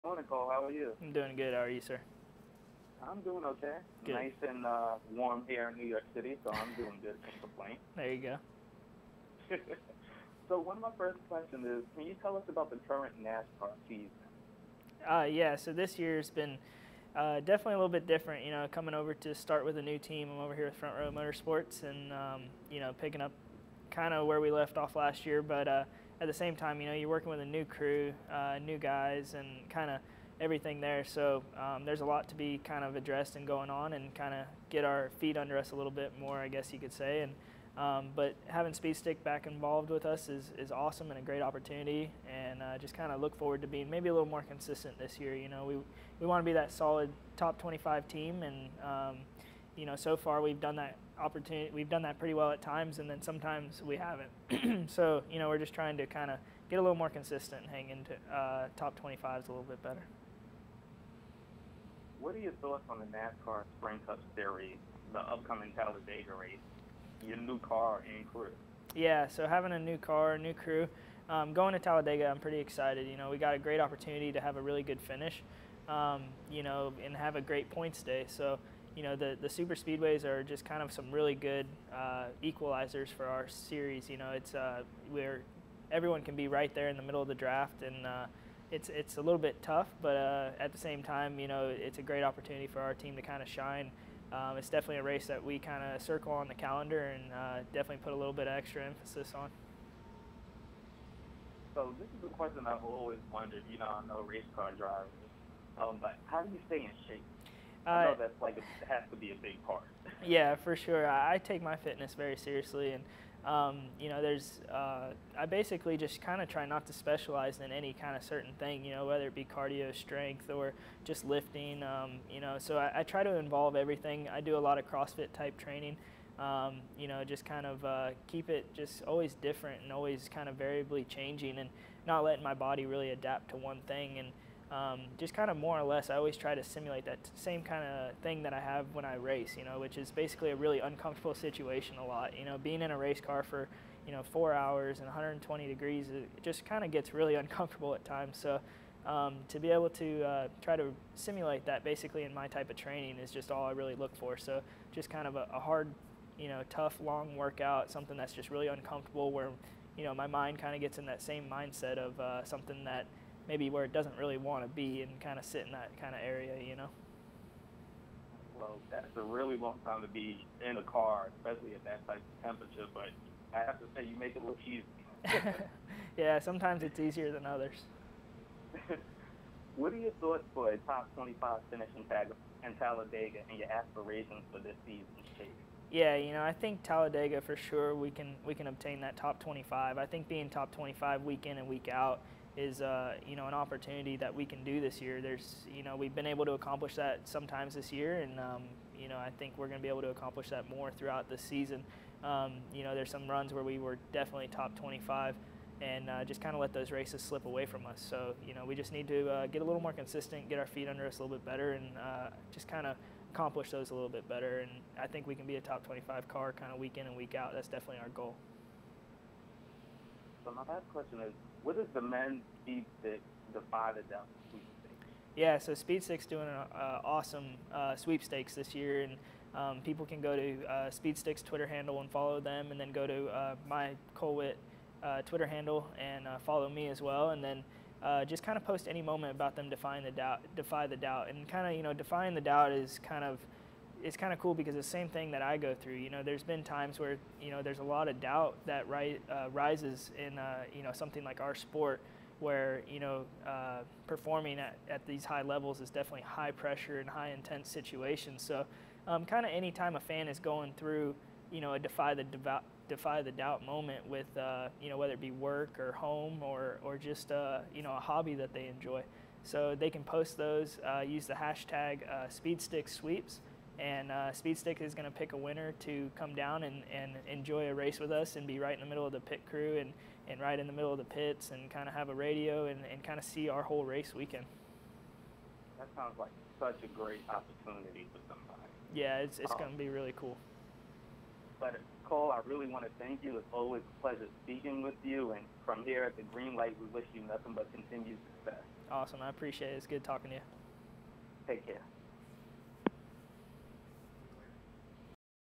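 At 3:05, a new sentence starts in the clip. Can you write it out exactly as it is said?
Yeah, you know, I think Talladega for sure we can we can obtain that top 25.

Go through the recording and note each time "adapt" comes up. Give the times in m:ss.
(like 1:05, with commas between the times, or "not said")
2:13.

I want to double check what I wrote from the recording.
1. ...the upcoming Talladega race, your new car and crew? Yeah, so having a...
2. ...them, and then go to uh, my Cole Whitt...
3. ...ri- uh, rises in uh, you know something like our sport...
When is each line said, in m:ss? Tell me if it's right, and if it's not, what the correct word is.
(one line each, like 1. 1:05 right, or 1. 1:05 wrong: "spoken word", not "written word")
1. 1:05 right
2. 3:52 right
3. 4:08 right.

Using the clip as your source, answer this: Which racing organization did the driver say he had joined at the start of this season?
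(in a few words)
Front Row Motorsports.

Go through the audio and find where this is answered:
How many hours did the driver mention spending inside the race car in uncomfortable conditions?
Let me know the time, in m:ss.
2:24.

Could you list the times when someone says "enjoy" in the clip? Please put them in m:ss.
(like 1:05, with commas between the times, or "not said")
4:28, 4:37.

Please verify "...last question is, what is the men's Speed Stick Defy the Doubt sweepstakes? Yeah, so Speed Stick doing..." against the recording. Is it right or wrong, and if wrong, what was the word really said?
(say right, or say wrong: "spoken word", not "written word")
right.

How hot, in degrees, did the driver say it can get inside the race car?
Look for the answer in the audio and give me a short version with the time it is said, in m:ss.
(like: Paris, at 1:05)
120 degrees, at 2:25.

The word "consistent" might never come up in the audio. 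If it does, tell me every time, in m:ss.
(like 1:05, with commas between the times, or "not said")
0:44, 0:57, 3:29.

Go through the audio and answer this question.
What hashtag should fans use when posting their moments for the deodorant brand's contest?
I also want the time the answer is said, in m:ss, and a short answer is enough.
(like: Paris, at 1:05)
#SpeedStickSweeps, at 4:32.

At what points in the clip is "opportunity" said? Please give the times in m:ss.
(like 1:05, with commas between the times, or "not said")
0:41, 0:51, 1:13, 1:32, 3:13, 4:47.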